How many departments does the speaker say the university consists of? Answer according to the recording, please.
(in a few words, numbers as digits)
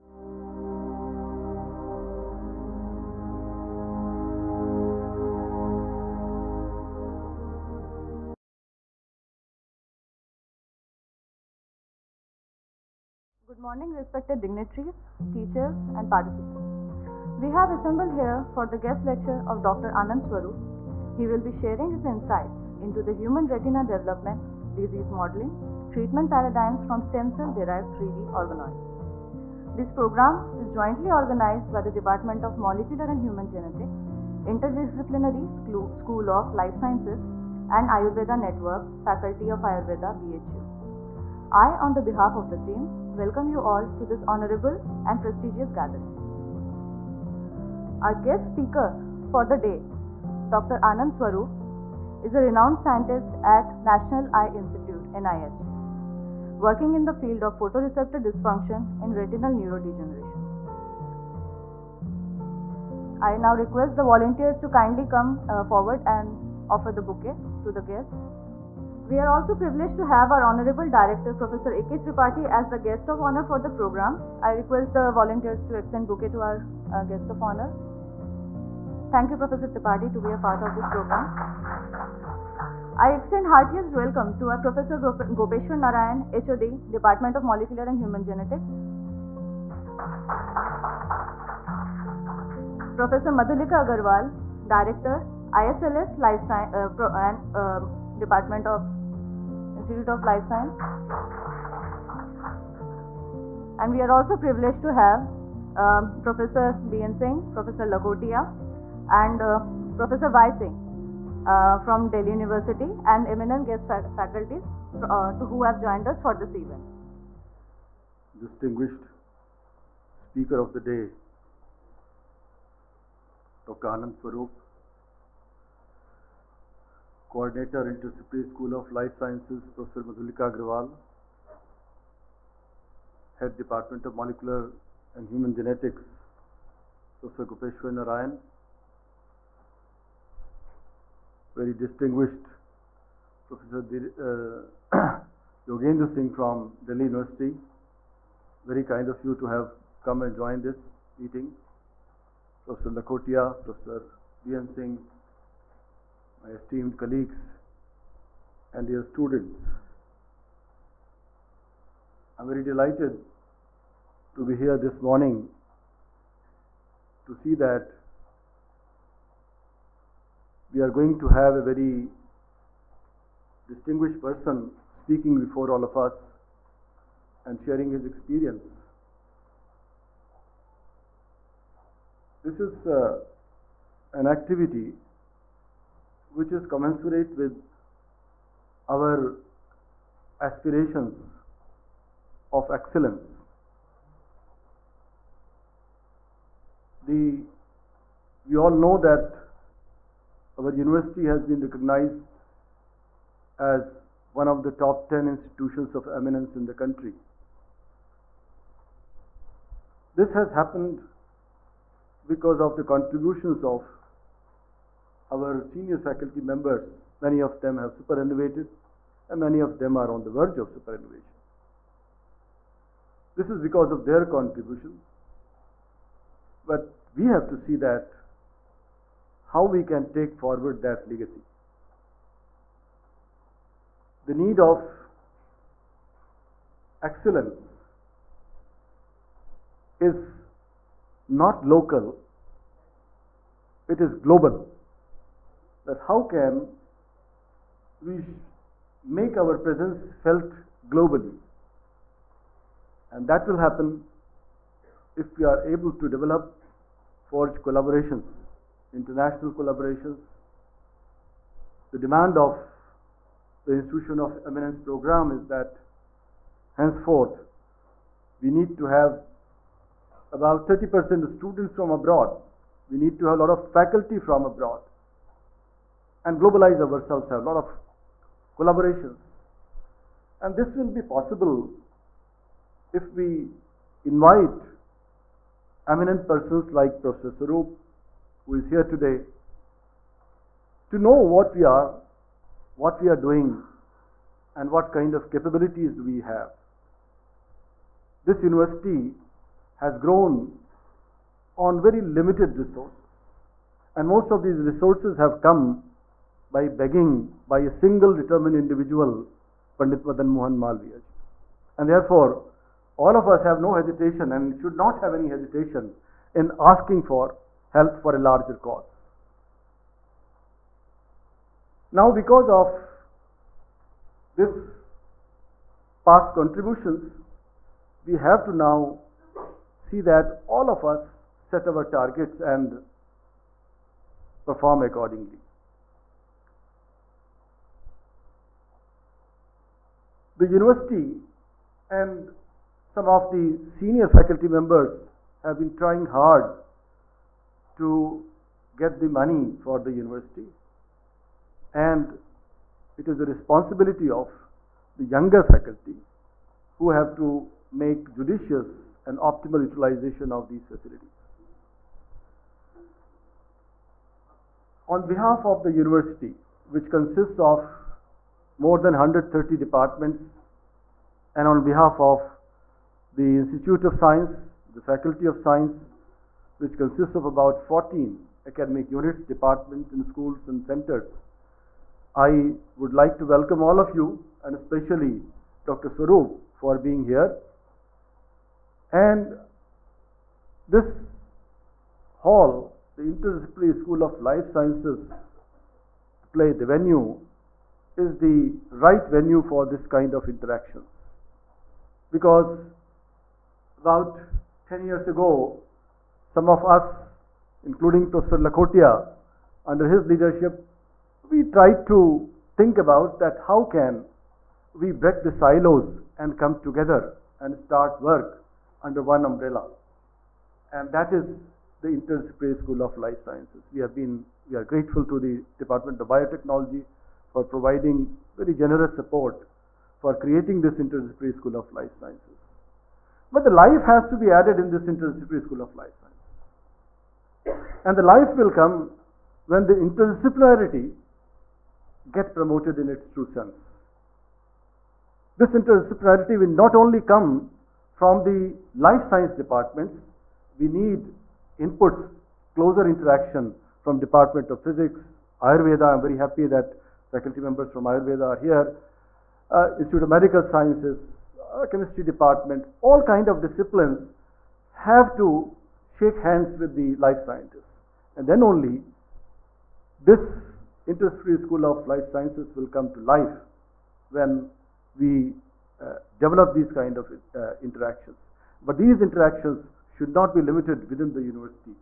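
more than 130.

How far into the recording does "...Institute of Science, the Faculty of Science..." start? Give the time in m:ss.
6:13.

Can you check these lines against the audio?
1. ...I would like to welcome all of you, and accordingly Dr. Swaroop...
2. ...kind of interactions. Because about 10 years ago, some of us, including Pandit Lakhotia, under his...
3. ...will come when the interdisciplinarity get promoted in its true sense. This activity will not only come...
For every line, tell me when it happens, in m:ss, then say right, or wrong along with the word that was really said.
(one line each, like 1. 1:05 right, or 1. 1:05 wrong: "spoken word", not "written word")
1. 6:22 wrong: "especially", not "accordingly"
2. 6:39 wrong: "Professor", not "Pandit"
3. 7:18 wrong: "interdisciplinarity", not "activity".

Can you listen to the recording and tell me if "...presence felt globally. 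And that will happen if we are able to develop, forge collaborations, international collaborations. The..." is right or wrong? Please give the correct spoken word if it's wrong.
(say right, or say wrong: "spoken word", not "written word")
right.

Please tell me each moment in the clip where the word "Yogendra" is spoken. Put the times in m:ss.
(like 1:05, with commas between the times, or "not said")
2:25.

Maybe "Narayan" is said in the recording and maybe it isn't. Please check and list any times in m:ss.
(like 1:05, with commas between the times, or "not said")
1:25, 2:17.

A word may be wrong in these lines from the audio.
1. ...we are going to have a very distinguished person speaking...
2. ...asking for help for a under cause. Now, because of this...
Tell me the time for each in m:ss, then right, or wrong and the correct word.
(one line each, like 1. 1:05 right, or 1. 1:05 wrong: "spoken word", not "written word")
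1. 2:50 right
2. 5:16 wrong: "larger", not "under".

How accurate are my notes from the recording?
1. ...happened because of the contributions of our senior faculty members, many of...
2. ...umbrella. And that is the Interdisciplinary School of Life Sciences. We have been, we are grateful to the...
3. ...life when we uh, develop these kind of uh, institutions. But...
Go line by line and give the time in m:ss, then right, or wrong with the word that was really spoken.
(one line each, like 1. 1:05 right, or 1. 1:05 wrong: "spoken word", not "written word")
1. 3:30 right
2. 6:59 right
3. 7:53 wrong: "interactions", not "institutions".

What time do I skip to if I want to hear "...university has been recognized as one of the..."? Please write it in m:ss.
3:20.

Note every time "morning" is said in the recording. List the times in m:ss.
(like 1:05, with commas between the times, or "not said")
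0:13, 2:45.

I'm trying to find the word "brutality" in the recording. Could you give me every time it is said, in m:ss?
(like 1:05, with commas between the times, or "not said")
not said.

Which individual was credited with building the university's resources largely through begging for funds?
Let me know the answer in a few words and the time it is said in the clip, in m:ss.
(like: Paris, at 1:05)
Pandit Madan Mohan Malviya, at 5:09.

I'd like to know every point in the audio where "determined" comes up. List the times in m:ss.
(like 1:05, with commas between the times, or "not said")
5:08.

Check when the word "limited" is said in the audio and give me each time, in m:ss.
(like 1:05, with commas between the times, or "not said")
5:02, 8:00.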